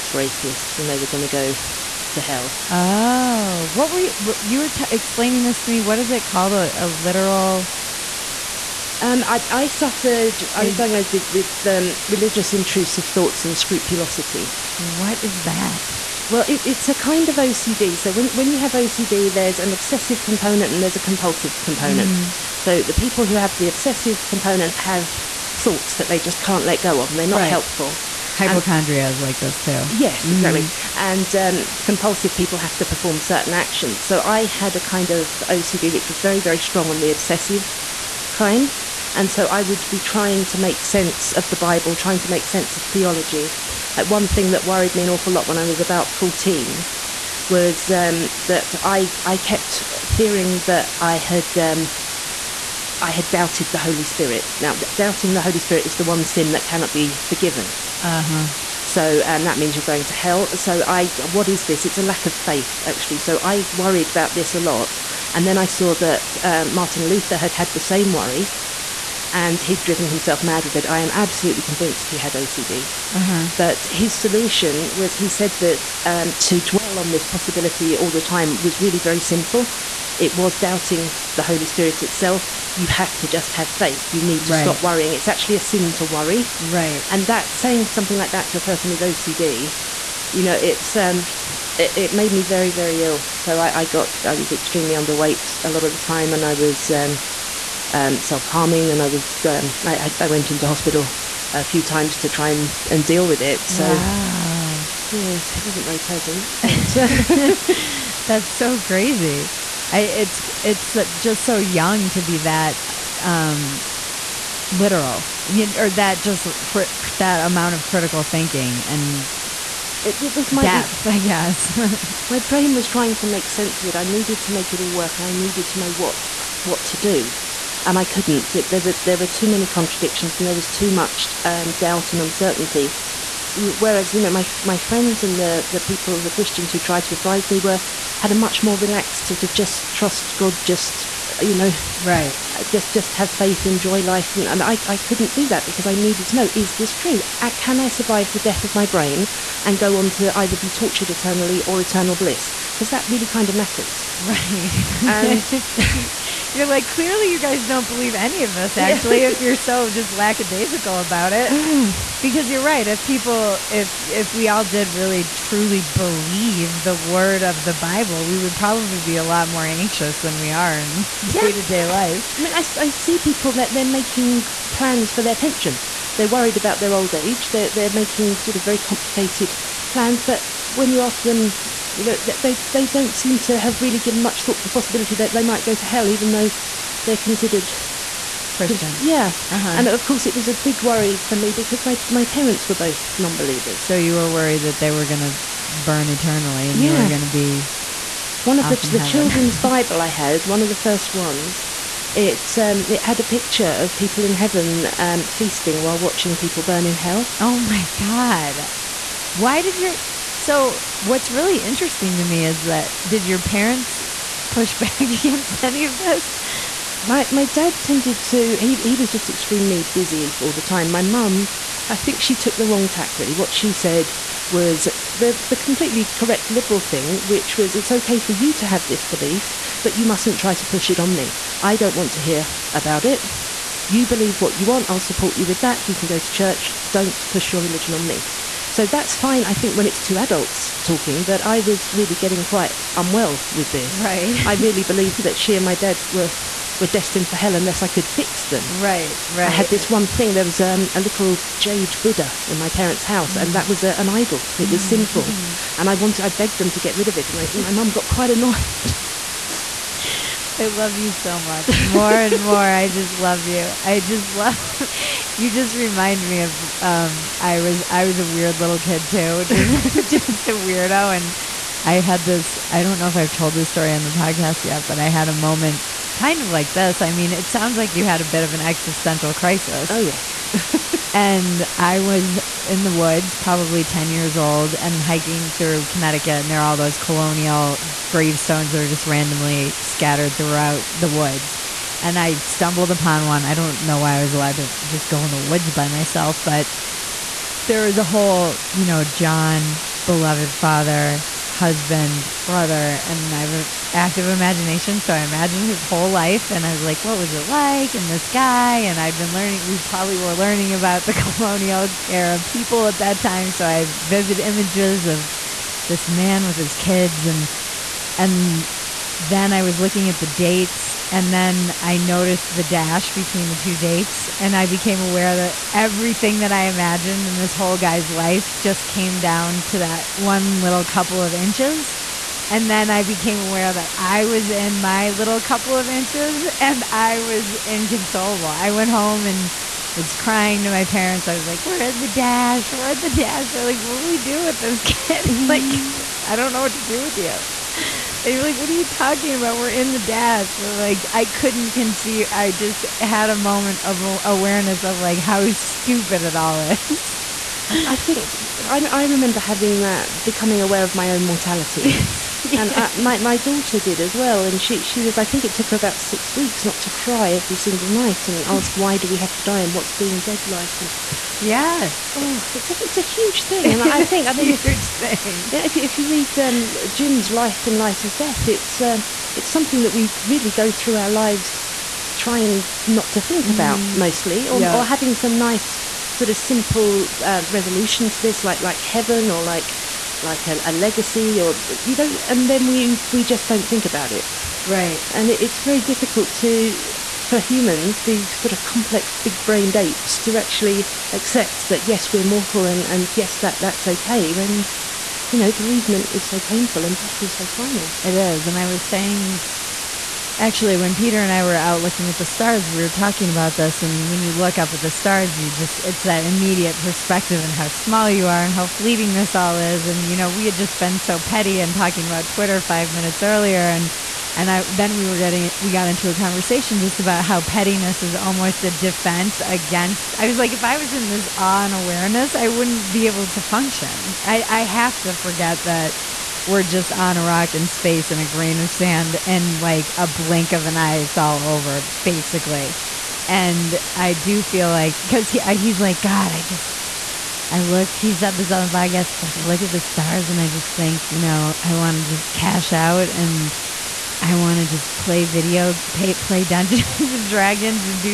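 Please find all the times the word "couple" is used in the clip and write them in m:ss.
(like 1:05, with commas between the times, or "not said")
5:30, 5:35.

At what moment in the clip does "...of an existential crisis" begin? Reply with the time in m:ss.
4:38.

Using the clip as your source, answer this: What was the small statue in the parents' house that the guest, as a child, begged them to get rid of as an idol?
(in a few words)
Jade Buddha.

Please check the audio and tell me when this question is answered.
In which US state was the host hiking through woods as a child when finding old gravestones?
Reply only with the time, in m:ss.
4:45.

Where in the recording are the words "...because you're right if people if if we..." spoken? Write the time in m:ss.
2:42.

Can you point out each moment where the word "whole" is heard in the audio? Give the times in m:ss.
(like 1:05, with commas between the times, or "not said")
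4:58, 5:05, 5:27.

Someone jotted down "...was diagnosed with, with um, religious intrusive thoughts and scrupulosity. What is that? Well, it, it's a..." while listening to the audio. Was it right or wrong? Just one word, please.
right.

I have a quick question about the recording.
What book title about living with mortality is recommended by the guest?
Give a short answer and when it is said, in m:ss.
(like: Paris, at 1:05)
Life in Light of Death, at 6:17.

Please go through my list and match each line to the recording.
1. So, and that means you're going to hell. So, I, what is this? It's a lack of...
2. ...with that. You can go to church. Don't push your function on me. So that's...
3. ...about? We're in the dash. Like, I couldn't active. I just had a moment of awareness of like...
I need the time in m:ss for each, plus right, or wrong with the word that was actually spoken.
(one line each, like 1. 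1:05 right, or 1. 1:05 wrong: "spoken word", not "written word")
1. 0:58 right
2. 3:55 wrong: "religion", not "function"
3. 5:49 wrong: "conceive", not "active".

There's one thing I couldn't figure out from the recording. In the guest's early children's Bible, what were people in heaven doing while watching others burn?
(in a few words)
Feasting.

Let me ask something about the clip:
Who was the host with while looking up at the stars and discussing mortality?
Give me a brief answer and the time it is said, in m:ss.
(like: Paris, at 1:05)
Peter, at 6:50.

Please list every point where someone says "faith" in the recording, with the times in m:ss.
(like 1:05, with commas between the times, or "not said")
1:02, 1:23, 2:23.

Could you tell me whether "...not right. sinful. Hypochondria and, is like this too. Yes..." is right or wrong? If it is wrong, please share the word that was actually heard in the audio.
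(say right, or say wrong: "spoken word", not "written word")
wrong: "helpful", not "sinful".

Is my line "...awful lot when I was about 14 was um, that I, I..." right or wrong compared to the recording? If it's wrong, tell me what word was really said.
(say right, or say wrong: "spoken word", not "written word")
right.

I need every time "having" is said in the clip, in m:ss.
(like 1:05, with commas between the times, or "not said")
5:59, 6:24.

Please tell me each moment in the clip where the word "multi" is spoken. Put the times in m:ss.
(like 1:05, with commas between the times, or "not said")
not said.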